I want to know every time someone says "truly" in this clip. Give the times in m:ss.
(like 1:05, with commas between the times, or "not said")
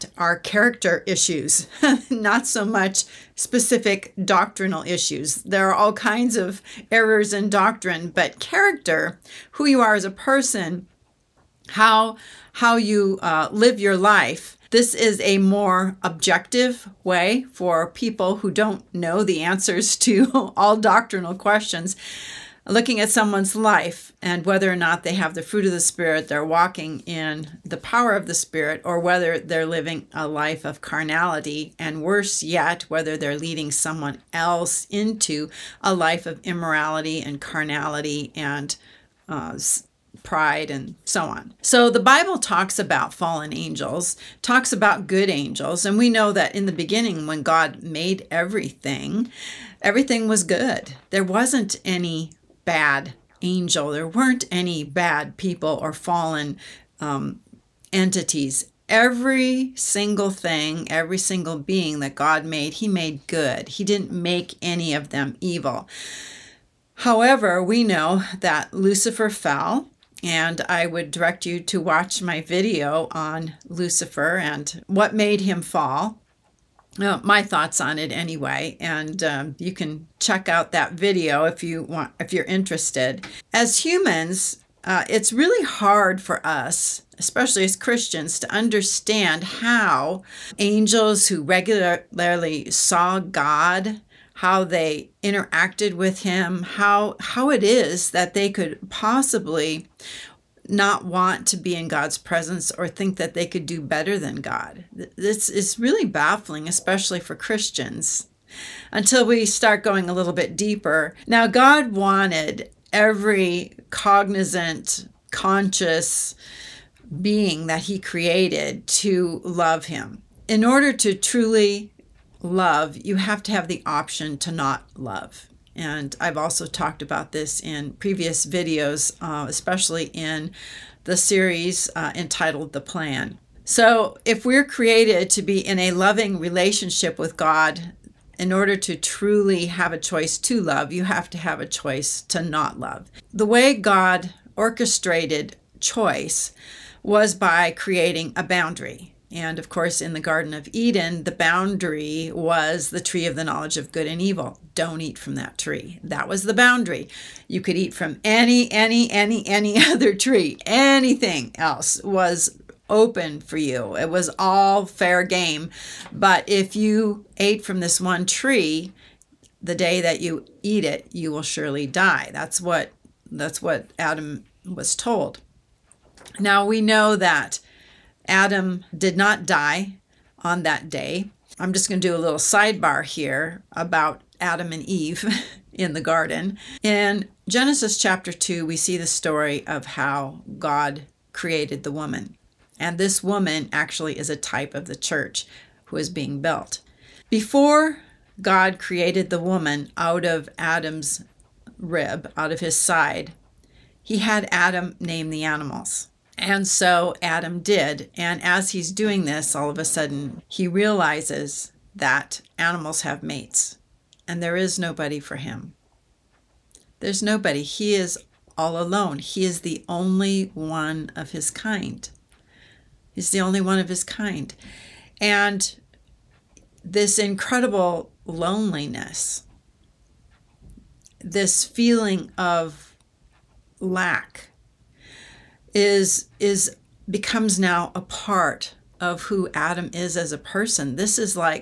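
2:01, 2:18.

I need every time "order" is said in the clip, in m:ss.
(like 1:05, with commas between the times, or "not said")
2:00, 2:18.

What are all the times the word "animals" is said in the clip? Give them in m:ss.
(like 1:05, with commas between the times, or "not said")
3:25, 3:32.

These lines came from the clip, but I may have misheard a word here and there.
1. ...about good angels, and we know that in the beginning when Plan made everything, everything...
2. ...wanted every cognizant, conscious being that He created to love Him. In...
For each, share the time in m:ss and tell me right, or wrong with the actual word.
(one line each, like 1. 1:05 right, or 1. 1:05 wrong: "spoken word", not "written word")
1. 0:44 wrong: "God", not "Plan"
2. 1:51 right.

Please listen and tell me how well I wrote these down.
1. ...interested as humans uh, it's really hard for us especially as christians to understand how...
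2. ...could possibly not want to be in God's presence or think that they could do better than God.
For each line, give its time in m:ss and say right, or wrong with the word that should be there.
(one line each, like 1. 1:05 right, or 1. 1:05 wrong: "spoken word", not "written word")
1. 1:22 right
2. 1:38 right.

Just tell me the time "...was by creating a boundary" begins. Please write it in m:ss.
2:27.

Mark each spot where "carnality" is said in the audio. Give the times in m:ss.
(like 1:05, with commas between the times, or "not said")
0:30, 0:37.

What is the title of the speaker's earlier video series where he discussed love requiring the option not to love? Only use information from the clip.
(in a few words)
The Plan.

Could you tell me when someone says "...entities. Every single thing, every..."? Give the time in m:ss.
0:57.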